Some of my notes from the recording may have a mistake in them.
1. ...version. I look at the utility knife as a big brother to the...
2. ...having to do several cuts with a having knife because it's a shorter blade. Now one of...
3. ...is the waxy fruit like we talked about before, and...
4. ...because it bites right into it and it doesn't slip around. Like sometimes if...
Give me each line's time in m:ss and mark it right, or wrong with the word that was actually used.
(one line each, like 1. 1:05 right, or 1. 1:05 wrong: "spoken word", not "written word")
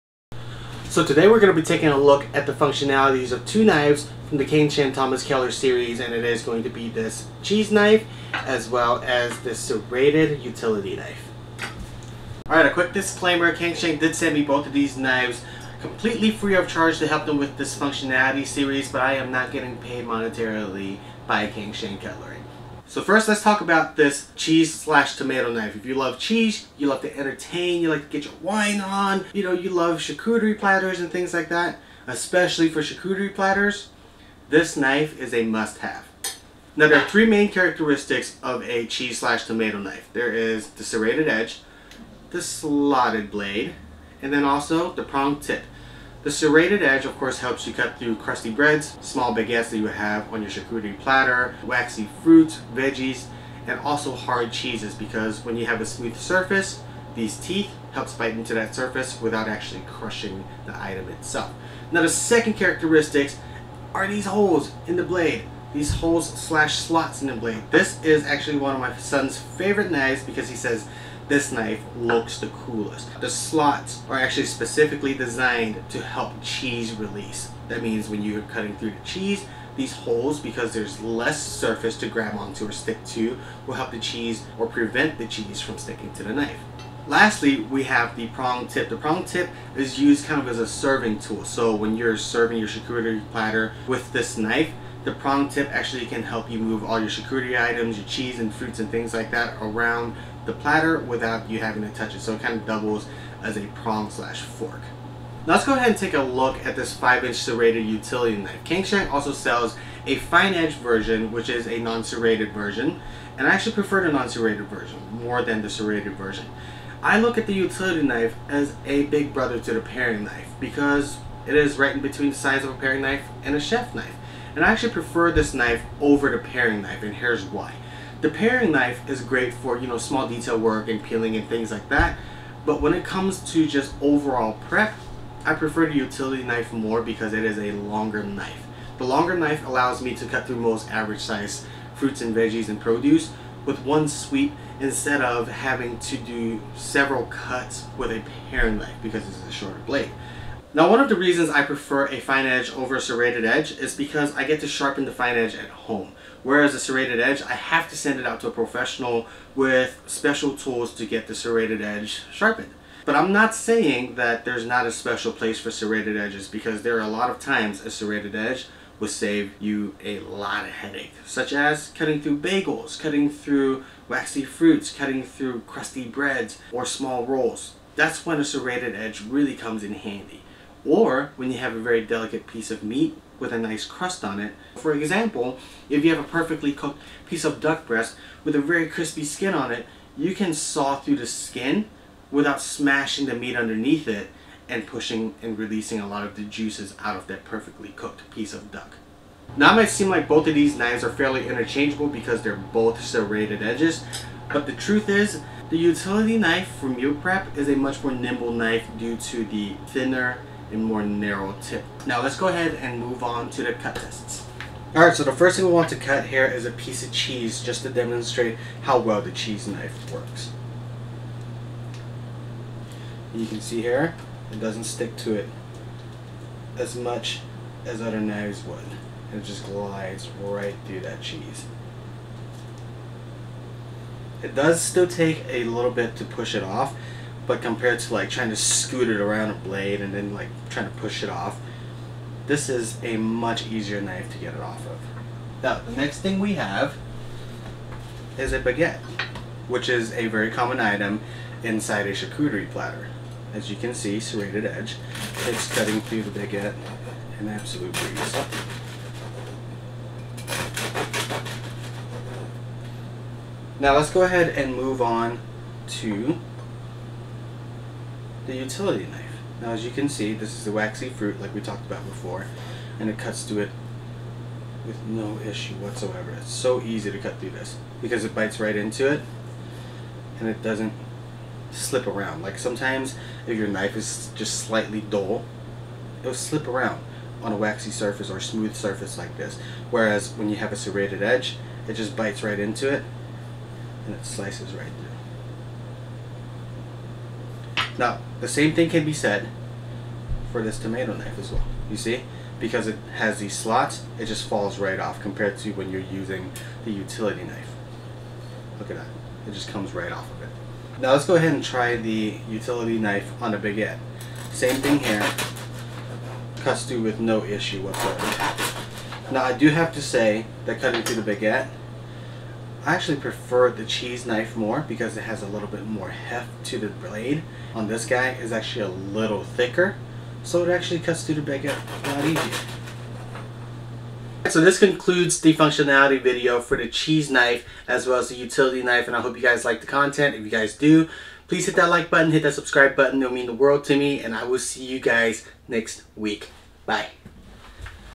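1. 1:56 right
2. 2:25 wrong: "paring", not "having"
3. 4:30 right
4. 4:38 right.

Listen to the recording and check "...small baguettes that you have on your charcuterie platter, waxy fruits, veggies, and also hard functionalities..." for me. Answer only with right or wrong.
wrong.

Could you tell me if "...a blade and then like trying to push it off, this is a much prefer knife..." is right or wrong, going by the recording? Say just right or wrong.
wrong.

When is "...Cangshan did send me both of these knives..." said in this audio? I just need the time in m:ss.
0:13.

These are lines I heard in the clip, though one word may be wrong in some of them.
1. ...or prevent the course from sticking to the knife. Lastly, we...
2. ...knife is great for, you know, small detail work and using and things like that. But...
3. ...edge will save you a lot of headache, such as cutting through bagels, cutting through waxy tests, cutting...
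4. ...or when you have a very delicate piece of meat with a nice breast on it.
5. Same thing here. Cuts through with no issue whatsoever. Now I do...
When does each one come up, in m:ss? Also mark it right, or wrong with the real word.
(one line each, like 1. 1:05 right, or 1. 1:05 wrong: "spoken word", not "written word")
1. 1:24 wrong: "cheese", not "course"
2. 2:08 wrong: "peeling", not "using"
3. 2:48 wrong: "fruits", not "tests"
4. 3:00 wrong: "crust", not "breast"
5. 5:14 right.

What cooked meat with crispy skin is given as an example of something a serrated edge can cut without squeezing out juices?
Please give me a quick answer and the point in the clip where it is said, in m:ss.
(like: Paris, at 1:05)
Duck breast, at 3:07.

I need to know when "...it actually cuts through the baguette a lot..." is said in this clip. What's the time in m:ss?
5:30.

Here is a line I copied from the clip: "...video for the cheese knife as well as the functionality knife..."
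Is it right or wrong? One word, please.
wrong.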